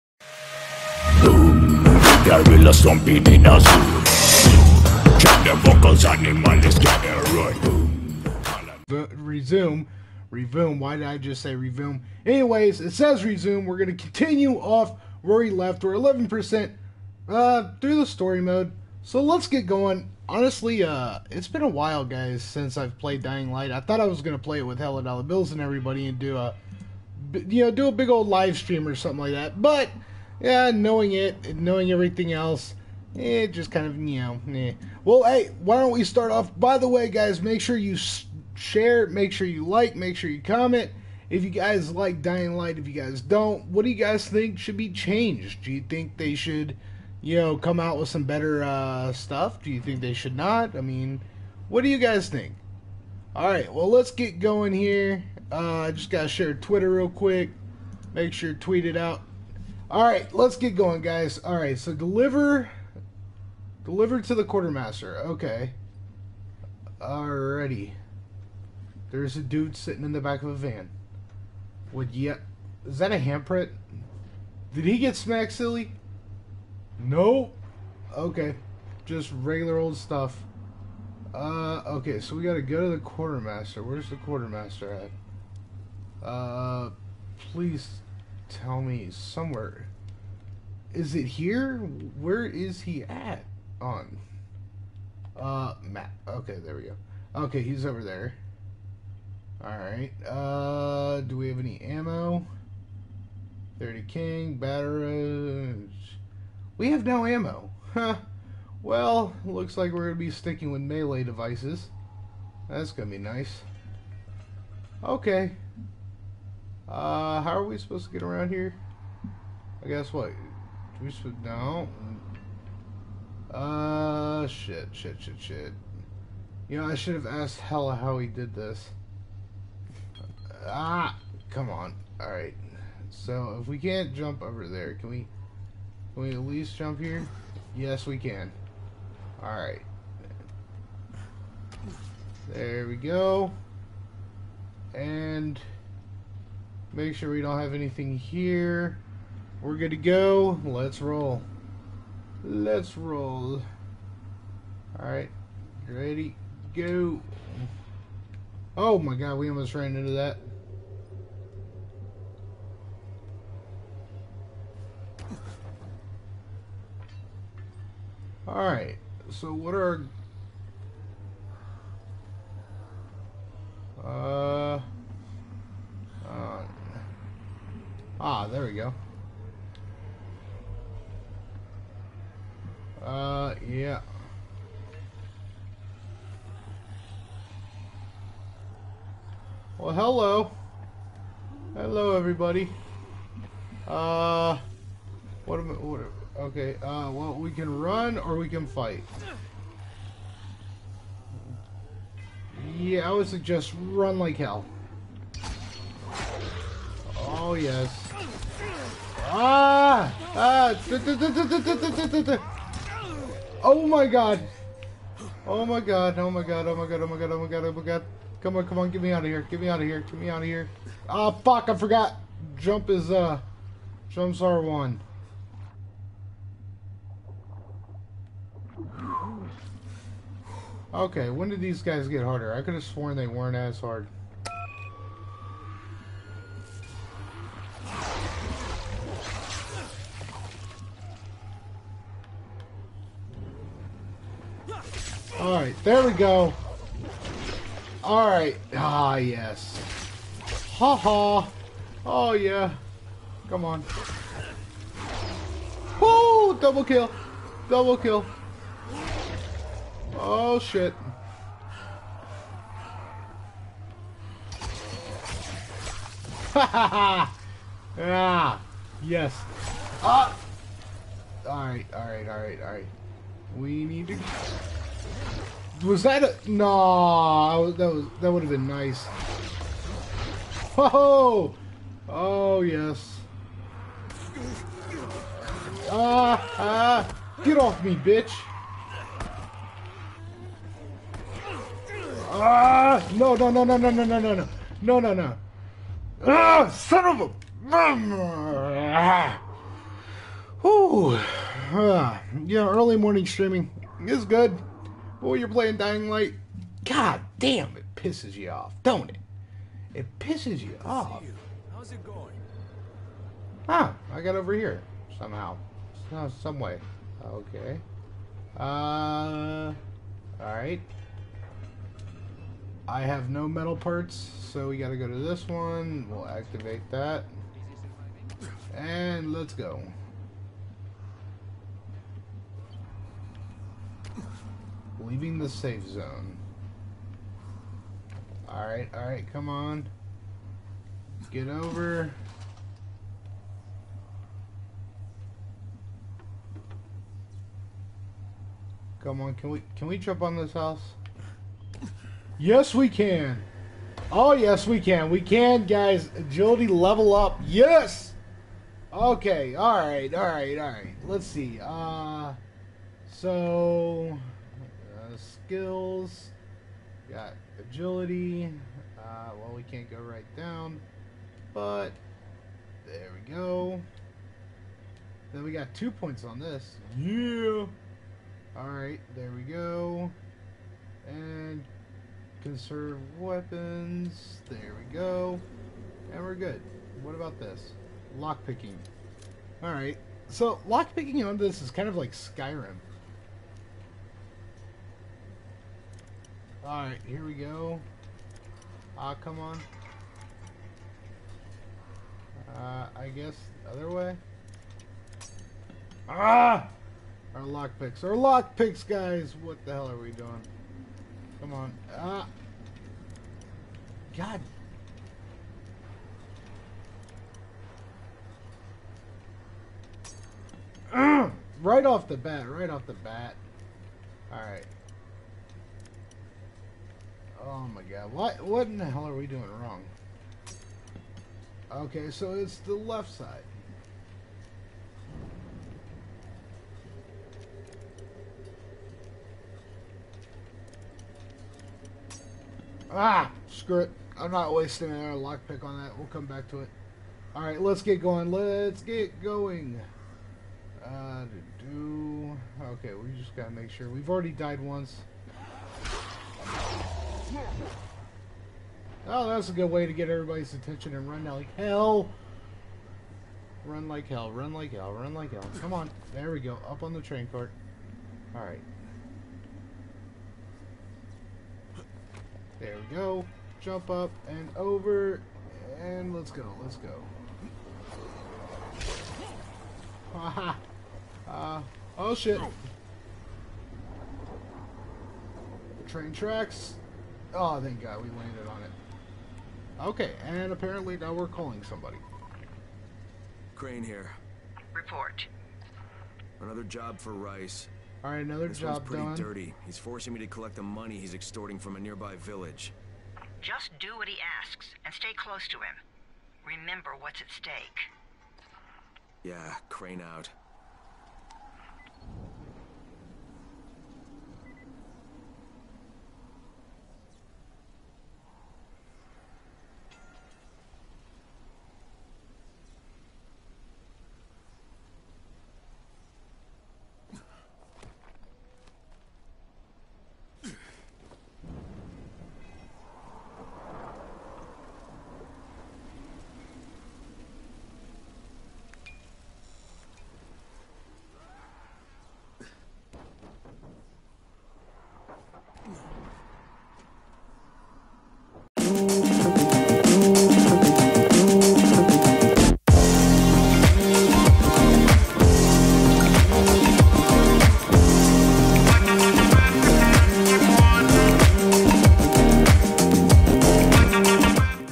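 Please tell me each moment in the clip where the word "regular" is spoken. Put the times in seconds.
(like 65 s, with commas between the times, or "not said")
79 s.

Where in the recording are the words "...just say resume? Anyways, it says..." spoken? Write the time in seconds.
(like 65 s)
11 s.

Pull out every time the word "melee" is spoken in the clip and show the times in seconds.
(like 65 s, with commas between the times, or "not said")
110 s.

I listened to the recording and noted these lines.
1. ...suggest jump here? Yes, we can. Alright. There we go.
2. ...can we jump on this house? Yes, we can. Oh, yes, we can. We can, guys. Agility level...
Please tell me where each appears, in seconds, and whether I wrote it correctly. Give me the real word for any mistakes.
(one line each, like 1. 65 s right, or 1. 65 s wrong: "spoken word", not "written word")
1. 136 s wrong: "least", not "suggest"
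2. 349 s right.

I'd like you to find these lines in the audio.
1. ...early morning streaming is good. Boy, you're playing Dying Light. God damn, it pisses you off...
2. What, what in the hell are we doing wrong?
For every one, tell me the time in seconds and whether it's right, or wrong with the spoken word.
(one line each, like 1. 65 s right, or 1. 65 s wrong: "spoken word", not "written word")
1. 302 s right
2. 428 s right.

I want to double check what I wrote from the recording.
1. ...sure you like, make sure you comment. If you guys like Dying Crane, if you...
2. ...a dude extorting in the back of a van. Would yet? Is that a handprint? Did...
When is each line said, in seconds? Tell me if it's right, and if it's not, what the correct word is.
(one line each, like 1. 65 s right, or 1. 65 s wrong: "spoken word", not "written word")
1. 39 s wrong: "Light", not "Crane"
2. 69 s wrong: "sitting", not "extorting".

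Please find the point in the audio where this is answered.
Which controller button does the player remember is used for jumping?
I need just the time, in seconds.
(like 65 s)
224 s.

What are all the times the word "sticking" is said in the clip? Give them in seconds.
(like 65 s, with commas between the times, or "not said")
110 s.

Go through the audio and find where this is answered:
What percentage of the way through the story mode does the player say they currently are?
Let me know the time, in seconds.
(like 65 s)
15 s.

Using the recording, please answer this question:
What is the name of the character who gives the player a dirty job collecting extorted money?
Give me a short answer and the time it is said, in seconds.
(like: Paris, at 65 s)
Rais, at 497 s.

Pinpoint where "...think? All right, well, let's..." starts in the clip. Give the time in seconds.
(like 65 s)
52 s.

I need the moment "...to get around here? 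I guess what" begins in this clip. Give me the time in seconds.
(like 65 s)
118 s.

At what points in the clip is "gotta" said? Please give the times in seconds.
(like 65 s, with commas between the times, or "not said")
82 s, 324 s, 453 s.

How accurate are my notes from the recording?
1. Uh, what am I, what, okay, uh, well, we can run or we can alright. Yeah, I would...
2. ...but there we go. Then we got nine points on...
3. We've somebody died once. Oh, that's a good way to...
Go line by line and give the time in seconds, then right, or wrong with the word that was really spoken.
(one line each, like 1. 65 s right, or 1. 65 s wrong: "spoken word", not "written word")
1. 193 s wrong: "fight", not "alright"
2. 371 s wrong: "two", not "nine"
3. 453 s wrong: "already", not "somebody".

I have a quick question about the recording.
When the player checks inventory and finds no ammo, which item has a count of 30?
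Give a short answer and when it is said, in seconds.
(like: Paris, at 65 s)
Batteries, at 104 s.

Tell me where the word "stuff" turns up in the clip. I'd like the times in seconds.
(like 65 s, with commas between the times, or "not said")
49 s, 79 s.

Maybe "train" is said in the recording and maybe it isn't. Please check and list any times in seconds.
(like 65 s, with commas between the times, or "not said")
467 s, 485 s.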